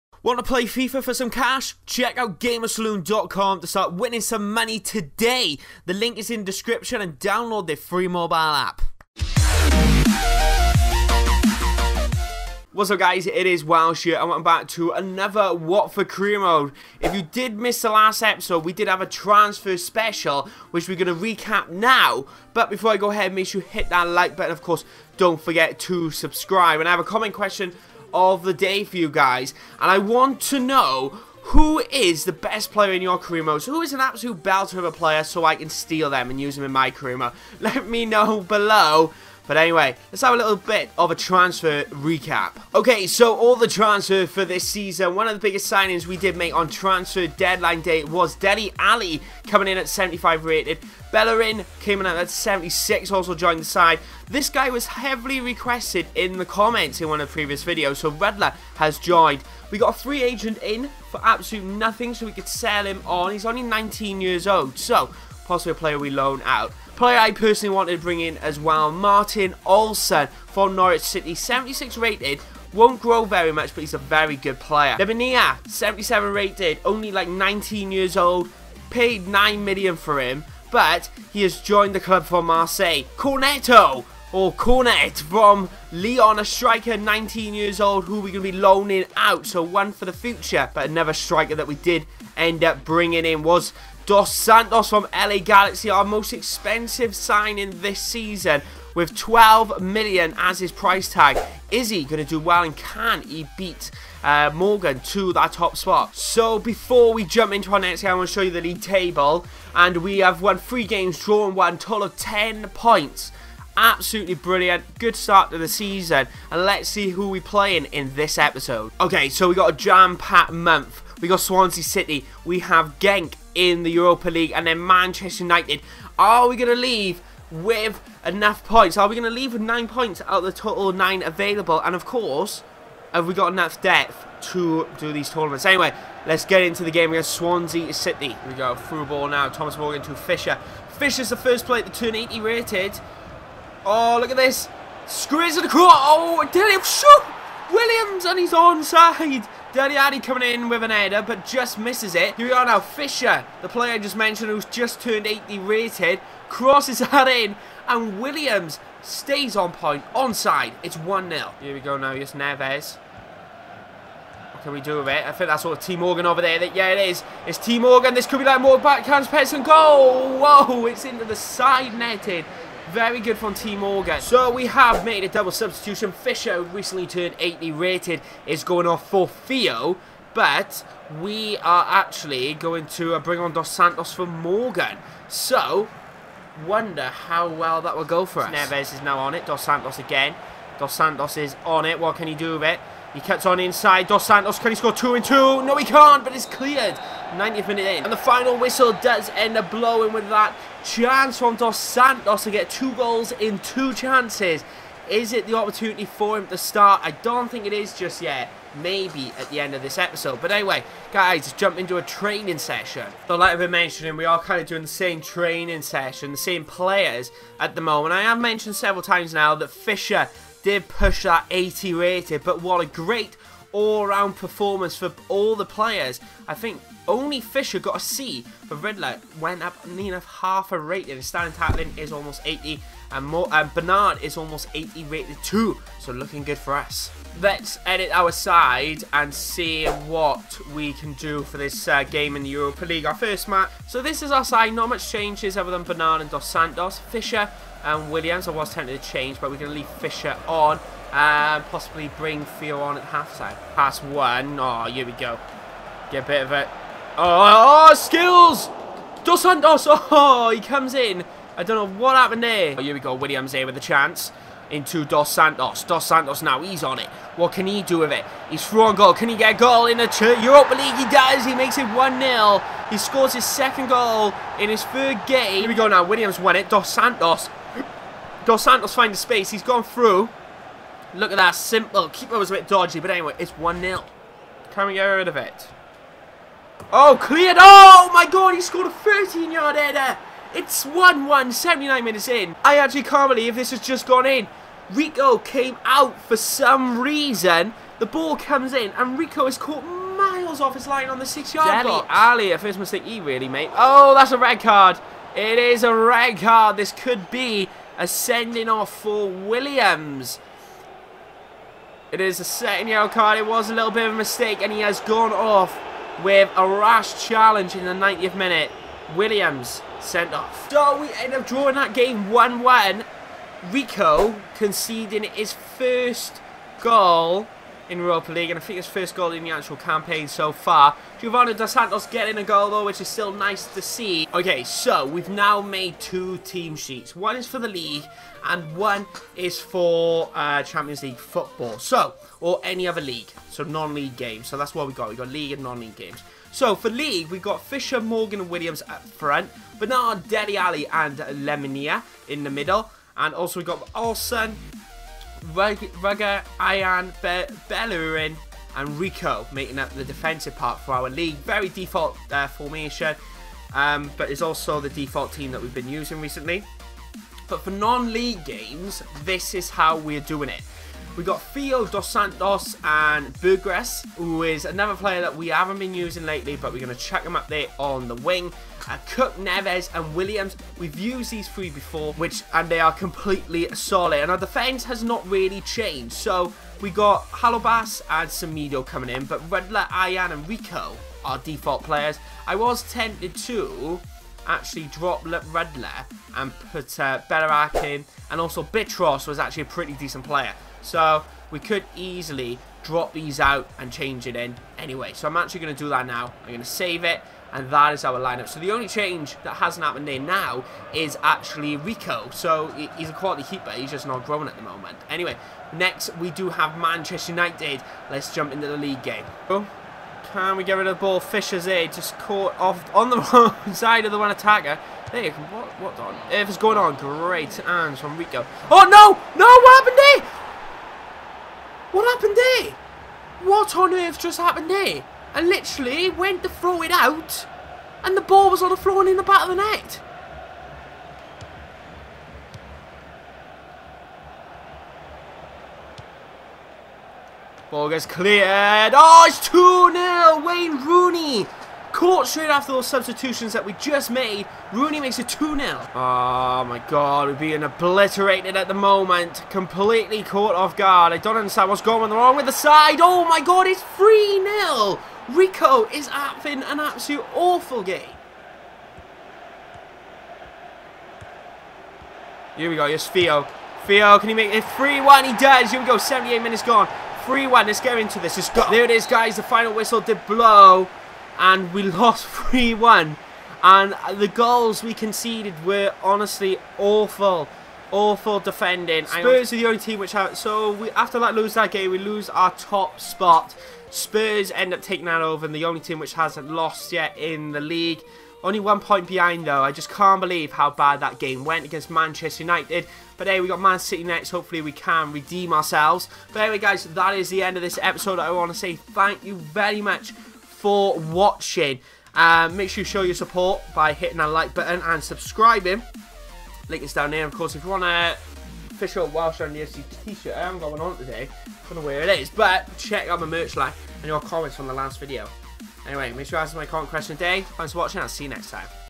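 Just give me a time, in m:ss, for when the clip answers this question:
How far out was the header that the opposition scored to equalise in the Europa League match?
4:48.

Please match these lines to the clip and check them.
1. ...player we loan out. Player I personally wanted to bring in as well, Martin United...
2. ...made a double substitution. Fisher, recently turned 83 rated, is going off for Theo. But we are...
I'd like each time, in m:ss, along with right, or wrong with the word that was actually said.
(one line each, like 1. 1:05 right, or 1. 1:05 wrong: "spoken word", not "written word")
1. 1:05 wrong: "Olsson", not "United"
2. 2:55 wrong: "80", not "83".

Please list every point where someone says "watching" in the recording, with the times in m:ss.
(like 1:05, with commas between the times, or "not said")
8:30, 8:47.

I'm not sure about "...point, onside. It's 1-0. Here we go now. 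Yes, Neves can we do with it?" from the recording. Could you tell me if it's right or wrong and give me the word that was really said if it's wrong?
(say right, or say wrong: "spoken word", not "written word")
right.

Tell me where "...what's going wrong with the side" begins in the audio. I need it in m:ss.
7:41.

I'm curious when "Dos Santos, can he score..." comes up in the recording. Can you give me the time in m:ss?
3:14.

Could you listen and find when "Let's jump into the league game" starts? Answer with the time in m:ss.
6:58.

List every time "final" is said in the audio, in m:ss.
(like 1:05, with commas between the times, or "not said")
3:18, 7:59.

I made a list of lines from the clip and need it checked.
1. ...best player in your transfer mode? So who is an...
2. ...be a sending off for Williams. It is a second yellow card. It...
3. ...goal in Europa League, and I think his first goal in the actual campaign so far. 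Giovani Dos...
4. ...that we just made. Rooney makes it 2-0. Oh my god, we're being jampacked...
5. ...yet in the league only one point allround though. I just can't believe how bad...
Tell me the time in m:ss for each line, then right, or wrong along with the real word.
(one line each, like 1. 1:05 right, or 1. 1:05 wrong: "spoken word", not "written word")
1. 0:32 wrong: "career", not "transfer"
2. 5:07 right
3. 5:26 right
4. 7:33 wrong: "obliterated", not "jampacked"
5. 8:16 wrong: "behind", not "allround".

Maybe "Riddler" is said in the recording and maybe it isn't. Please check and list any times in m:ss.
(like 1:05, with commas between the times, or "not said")
3:48.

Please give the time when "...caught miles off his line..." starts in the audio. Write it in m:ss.
4:59.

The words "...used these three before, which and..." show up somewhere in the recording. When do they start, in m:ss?
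6:20.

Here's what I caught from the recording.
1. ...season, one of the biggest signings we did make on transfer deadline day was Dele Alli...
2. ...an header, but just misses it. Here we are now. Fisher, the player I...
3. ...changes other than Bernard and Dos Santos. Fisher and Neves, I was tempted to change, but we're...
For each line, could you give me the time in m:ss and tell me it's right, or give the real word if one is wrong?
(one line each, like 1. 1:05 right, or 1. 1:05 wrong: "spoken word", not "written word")
1. 0:44 right
2. 2:30 right
3. 4:05 wrong: "Williams", not "Neves".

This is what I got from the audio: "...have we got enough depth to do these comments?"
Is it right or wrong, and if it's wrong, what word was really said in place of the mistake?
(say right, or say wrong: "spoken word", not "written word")
wrong: "tournaments", not "comments".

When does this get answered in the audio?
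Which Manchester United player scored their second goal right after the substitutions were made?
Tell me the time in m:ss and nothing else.
7:30.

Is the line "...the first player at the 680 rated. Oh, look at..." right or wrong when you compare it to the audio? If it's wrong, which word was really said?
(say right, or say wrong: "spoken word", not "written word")
wrong: "280", not "680".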